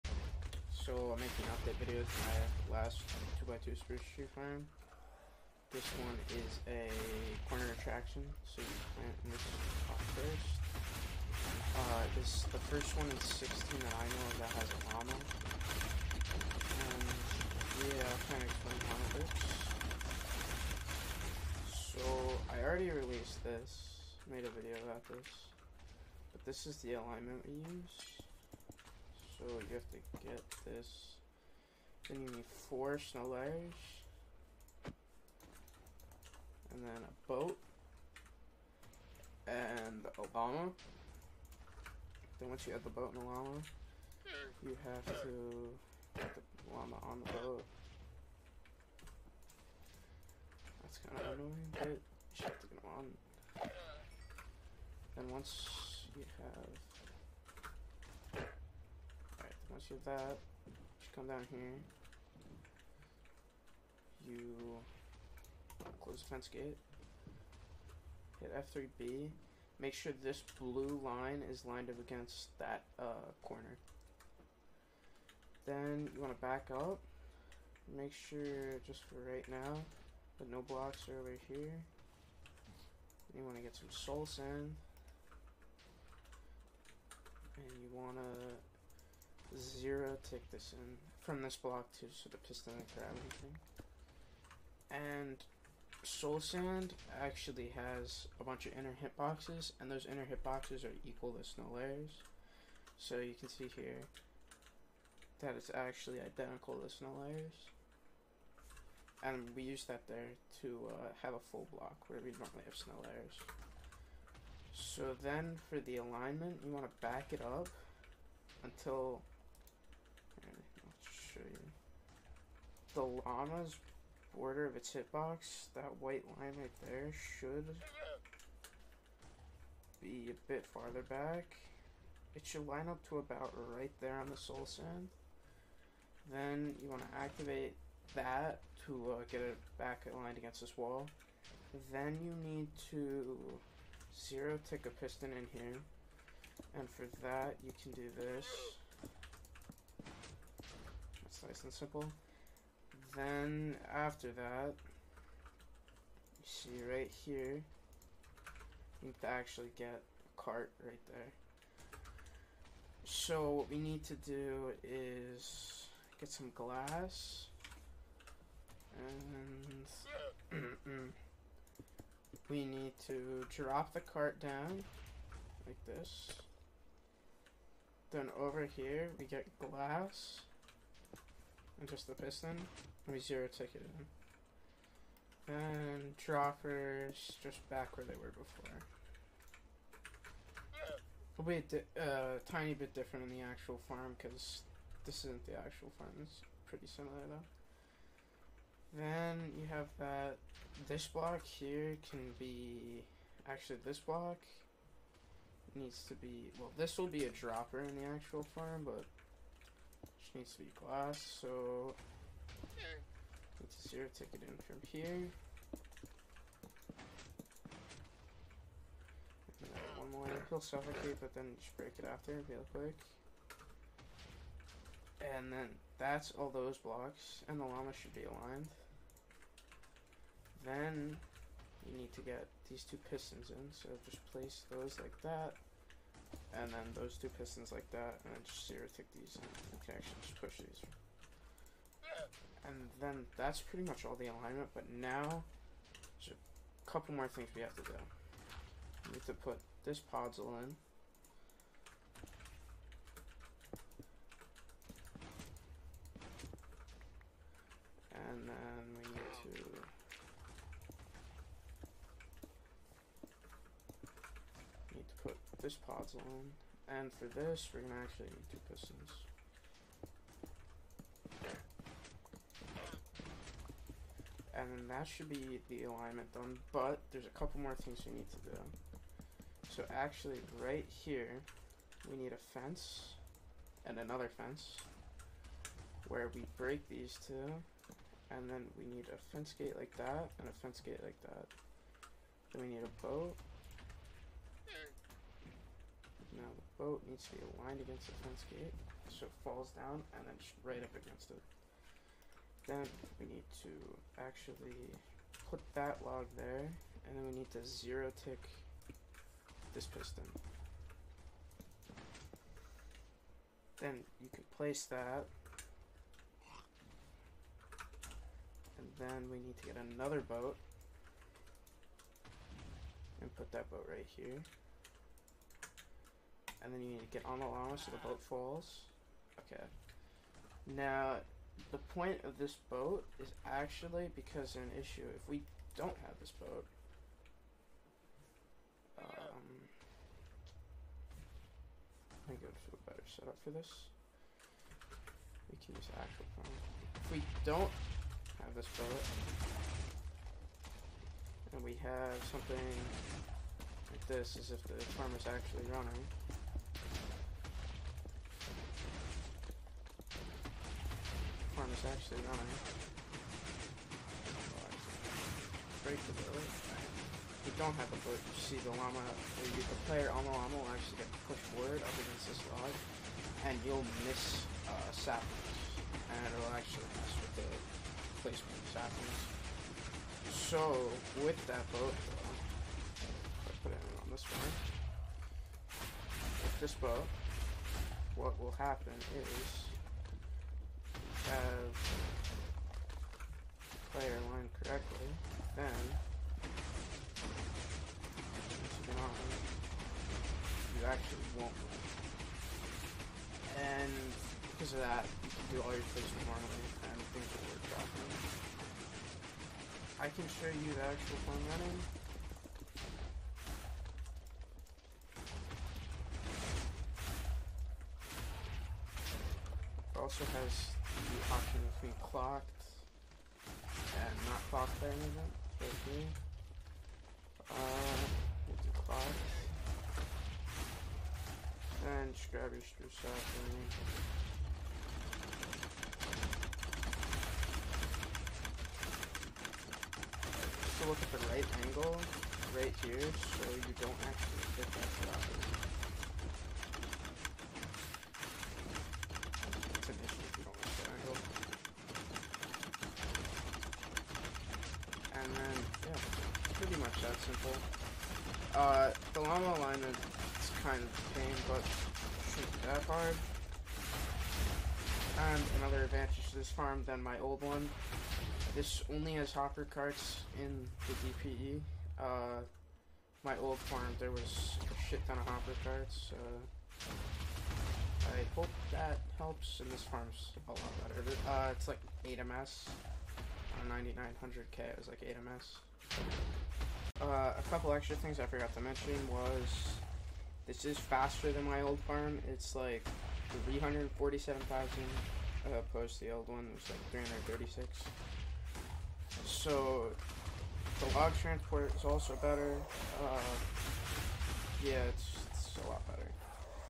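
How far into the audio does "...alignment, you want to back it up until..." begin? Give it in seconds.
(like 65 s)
115 s.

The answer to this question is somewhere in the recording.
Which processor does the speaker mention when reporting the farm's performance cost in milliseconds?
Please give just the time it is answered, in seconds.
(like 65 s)
483 s.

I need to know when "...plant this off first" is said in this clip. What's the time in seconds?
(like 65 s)
8 s.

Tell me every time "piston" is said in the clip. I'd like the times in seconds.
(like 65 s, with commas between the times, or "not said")
92 s, 144 s, 182 s, 233 s, 237 s, 268 s, 309 s.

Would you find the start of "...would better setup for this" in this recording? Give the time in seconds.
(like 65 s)
342 s.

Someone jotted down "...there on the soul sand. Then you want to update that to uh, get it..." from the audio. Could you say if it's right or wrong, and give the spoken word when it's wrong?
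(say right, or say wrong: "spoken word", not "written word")
wrong: "activate", not "update".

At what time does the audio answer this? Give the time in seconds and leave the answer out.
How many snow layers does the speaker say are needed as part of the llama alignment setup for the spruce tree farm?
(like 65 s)
32 s.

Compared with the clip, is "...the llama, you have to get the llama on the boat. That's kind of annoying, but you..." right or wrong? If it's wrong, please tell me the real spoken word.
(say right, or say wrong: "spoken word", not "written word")
right.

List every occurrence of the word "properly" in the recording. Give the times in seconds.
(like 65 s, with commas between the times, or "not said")
407 s, 445 s.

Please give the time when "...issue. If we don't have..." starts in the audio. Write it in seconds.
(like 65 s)
334 s.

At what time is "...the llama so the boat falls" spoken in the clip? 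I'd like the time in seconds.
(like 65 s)
327 s.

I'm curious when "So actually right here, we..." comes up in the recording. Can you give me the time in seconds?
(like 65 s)
279 s.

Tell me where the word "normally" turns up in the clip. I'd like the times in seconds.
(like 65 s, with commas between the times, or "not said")
112 s, 406 s.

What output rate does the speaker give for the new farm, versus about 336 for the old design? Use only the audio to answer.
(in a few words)
347,000.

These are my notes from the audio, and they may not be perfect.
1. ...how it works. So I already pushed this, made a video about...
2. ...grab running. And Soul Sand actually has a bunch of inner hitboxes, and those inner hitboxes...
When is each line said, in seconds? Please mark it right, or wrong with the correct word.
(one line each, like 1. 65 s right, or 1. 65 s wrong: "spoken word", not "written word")
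1. 18 s wrong: "released", not "pushed"
2. 92 s wrong: "anything", not "running".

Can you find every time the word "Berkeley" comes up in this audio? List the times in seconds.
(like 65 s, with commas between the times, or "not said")
not said.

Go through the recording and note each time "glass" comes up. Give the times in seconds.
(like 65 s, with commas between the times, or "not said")
166 s, 179 s, 210 s.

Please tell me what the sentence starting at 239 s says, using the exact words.
You can actually just push these.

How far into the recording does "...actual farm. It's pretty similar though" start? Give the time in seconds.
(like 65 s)
195 s.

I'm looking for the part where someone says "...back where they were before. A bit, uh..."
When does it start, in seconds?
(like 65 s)
187 s.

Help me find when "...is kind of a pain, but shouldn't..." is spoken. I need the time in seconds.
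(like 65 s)
459 s.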